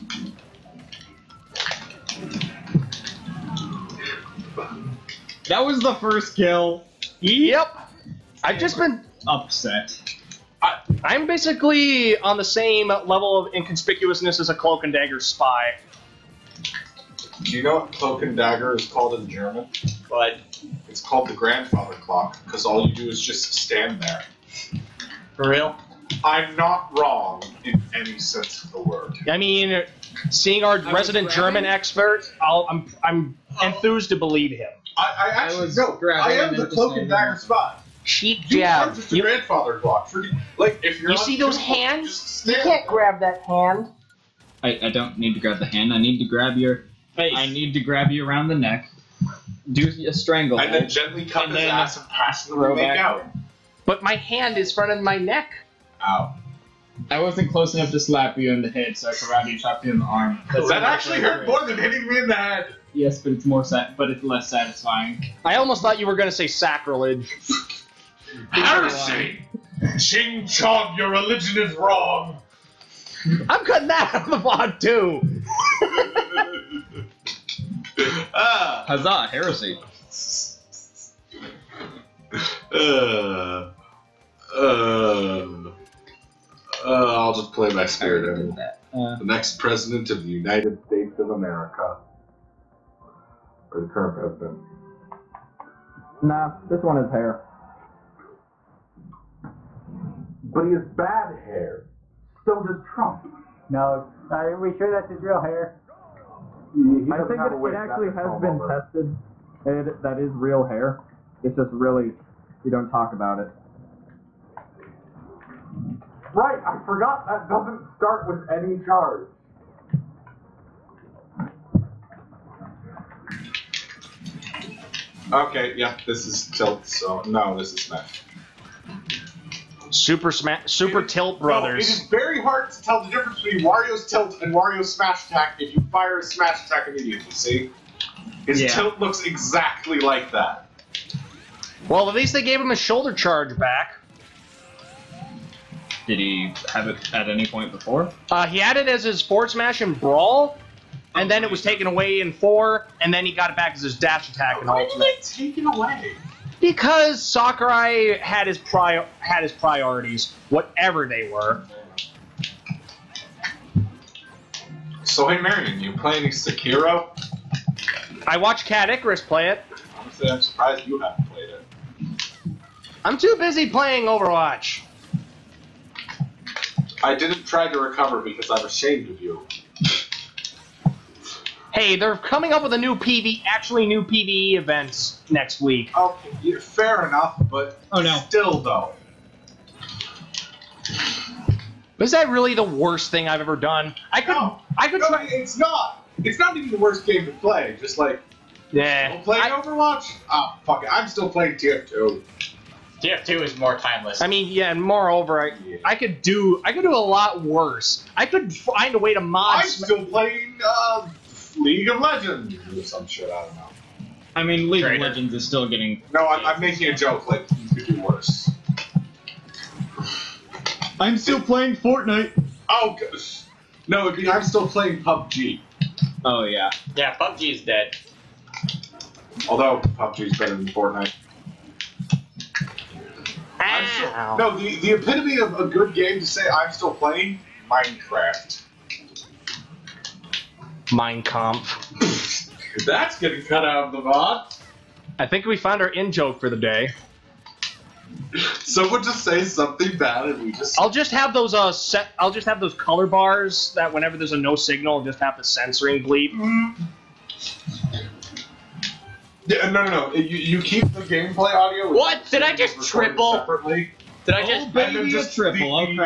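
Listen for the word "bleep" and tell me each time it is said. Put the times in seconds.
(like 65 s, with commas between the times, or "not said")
256 s.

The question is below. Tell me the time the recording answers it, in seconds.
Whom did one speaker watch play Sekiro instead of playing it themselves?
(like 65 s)
168 s.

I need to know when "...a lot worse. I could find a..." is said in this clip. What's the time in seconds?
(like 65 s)
206 s.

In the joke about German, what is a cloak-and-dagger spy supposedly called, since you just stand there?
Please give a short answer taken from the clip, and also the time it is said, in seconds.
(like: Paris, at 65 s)
the grandfather clock, at 21 s.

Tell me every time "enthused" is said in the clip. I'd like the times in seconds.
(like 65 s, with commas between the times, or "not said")
33 s.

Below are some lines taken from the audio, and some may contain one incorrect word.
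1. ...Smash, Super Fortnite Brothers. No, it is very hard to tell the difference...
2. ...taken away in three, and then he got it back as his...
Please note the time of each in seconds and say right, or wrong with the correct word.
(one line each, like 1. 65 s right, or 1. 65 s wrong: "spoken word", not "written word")
1. 130 s wrong: "Tilt", not "Fortnite"
2. 151 s wrong: "four", not "three".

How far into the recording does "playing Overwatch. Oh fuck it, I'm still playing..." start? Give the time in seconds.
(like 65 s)
199 s.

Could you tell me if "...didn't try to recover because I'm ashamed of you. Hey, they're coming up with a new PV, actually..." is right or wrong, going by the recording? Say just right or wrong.
right.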